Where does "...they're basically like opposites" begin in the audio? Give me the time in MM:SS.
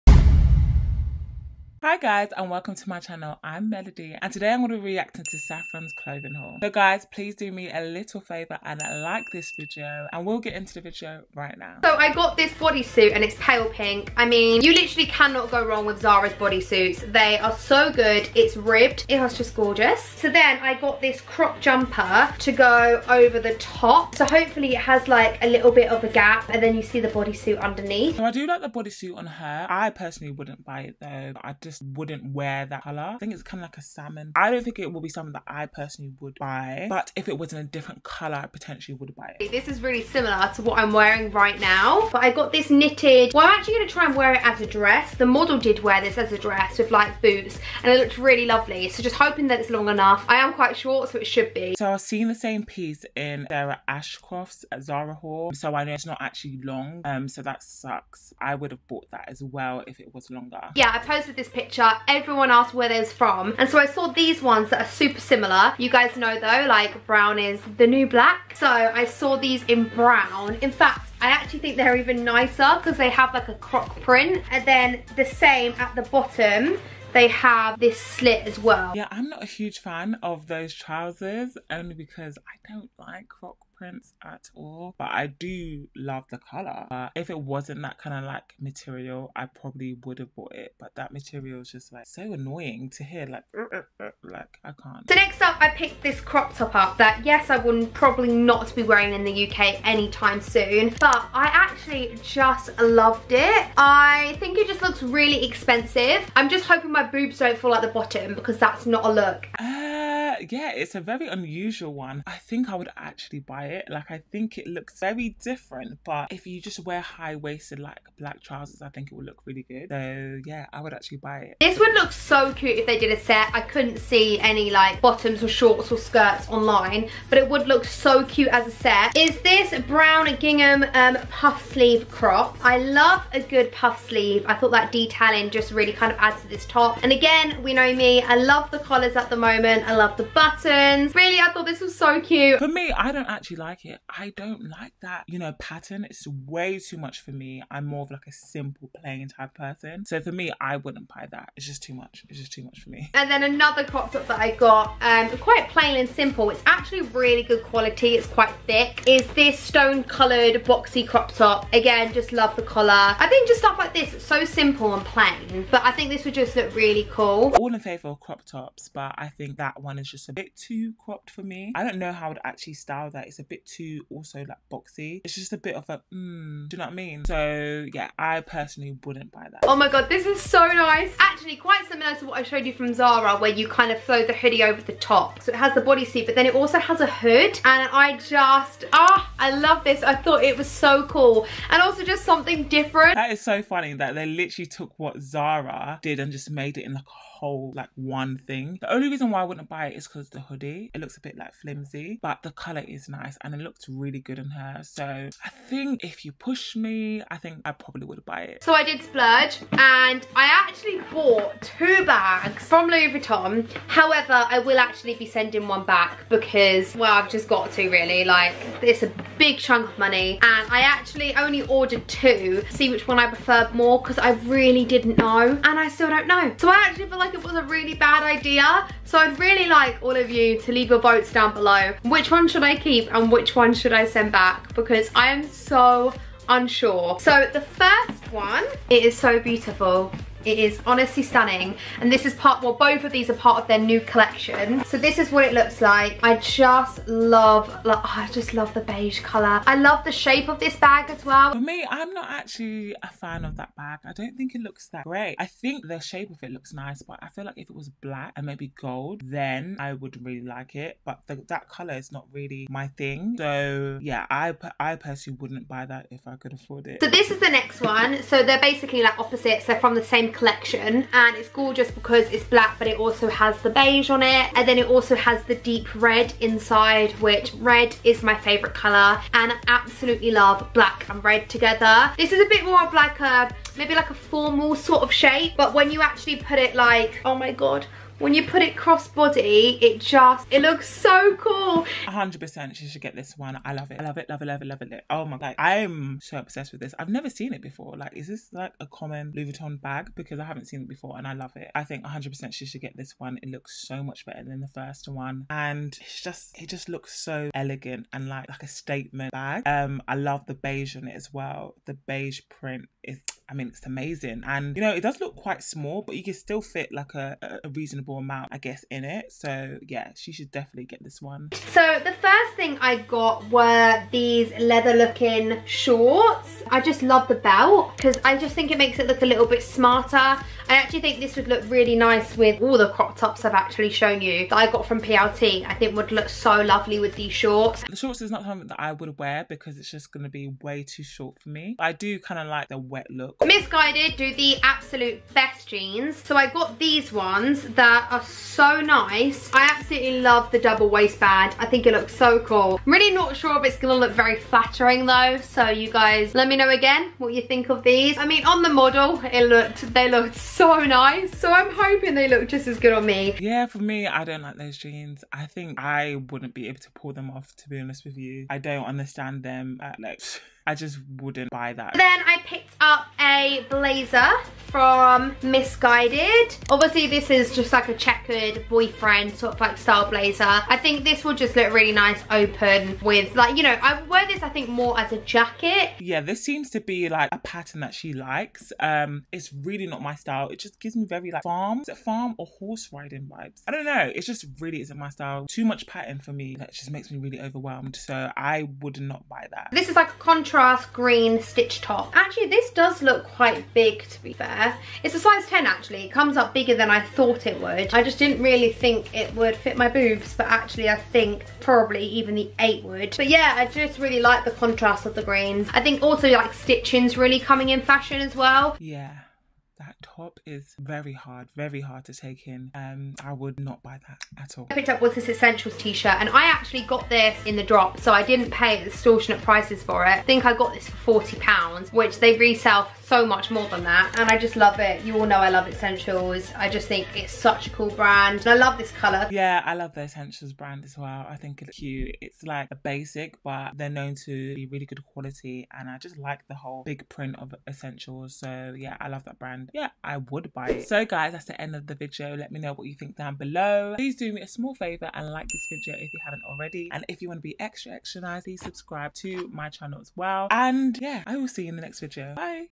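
04:28.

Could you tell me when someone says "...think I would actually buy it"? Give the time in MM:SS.
01:52.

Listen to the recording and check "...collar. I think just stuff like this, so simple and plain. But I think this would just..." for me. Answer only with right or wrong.
right.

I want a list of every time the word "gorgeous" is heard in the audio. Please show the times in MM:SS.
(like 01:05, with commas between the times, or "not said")
00:19, 04:31.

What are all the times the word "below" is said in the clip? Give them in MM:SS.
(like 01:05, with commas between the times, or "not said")
03:51, 07:33.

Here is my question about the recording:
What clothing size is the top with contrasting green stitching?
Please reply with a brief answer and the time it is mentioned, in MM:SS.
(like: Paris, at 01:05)
10, at 06:45.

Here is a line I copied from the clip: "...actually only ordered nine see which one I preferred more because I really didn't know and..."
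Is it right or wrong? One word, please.
wrong.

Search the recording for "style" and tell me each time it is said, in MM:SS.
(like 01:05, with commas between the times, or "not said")
02:52, 06:19, 06:30, 06:35.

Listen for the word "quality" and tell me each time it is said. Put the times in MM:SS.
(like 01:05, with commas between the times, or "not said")
02:37, 07:25.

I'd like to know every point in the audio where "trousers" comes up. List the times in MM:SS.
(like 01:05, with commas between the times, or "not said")
01:20, 01:58.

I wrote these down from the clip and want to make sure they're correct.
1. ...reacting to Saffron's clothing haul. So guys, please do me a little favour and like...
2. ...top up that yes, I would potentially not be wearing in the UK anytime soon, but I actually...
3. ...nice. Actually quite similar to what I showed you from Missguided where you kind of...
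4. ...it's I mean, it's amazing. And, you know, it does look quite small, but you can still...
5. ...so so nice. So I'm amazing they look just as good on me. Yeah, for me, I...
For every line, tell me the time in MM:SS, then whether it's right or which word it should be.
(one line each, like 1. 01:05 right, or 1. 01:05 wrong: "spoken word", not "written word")
1. 00:04 right
2. 01:36 wrong: "probably", not "potentially"
3. 03:00 wrong: "Zara", not "Missguided"
4. 05:13 right
5. 06:00 wrong: "hoping", not "amazing".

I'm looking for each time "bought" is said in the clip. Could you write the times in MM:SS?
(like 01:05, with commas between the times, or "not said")
00:58, 01:30, 03:31.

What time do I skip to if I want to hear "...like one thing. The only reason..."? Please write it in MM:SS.
03:17.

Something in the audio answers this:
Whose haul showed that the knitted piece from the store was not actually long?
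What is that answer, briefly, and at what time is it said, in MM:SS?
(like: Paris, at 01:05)
Sarah Ashcroft, at 00:53.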